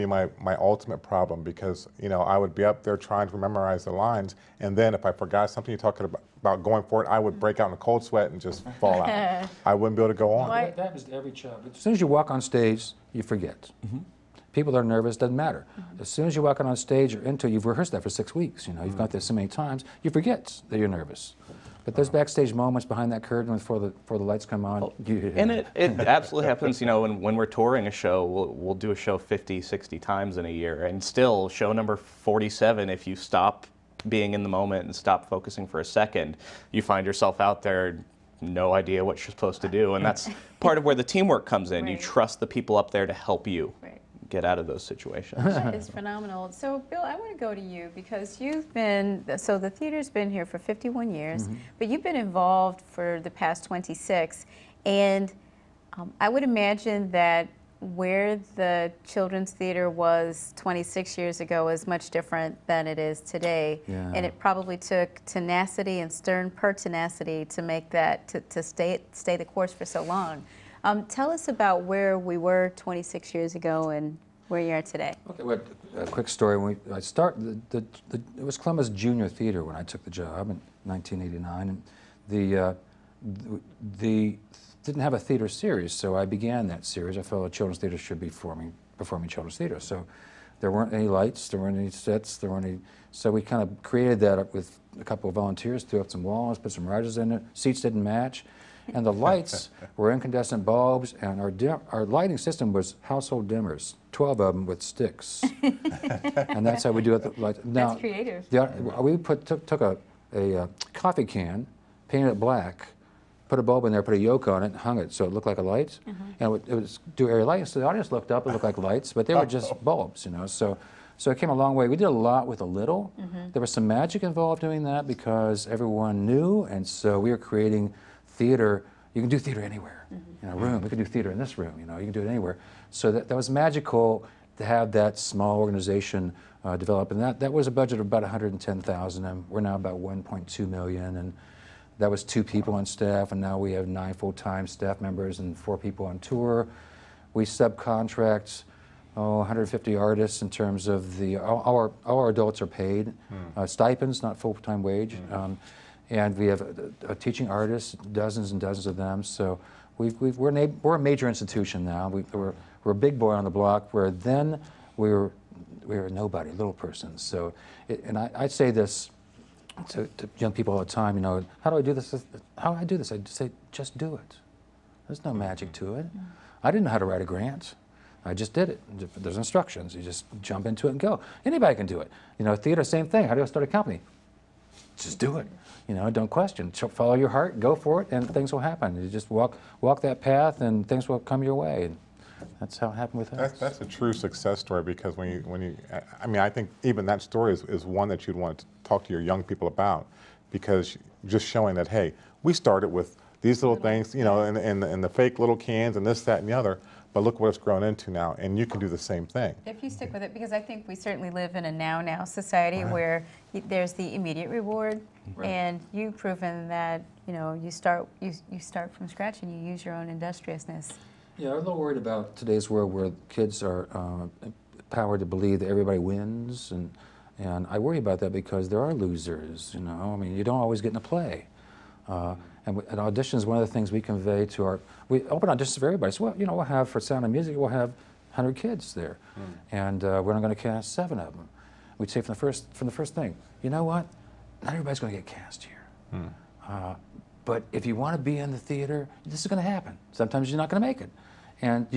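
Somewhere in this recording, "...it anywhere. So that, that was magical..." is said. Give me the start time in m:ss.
2:12.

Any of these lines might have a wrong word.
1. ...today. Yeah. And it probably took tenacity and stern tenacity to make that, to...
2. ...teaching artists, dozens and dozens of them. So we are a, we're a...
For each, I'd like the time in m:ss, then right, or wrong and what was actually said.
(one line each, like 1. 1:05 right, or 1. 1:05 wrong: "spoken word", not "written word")
1. 1:03 wrong: "pertinacity", not "tenacity"
2. 2:37 right.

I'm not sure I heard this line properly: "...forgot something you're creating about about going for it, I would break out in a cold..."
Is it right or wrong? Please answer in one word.
wrong.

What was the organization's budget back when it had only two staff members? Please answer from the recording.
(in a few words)
110,000.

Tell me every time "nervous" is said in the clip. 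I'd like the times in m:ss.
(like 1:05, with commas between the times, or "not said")
0:14, 0:20.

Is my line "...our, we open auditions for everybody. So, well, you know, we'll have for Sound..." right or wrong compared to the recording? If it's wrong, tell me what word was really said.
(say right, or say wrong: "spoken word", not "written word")
right.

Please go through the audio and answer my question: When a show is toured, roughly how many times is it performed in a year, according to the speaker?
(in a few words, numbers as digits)
50, 60.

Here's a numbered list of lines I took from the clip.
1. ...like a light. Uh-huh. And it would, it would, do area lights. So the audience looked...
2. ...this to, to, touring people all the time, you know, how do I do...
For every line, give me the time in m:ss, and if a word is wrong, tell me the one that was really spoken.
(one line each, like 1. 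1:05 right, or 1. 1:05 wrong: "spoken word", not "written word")
1. 1:55 right
2. 2:48 wrong: "young", not "touring".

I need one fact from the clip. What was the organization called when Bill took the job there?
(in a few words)
Columbus Junior Theater.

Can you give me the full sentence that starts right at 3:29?
If you stick with it, because I think we certainly live in a now now society right.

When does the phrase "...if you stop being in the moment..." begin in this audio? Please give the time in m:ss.
0:32.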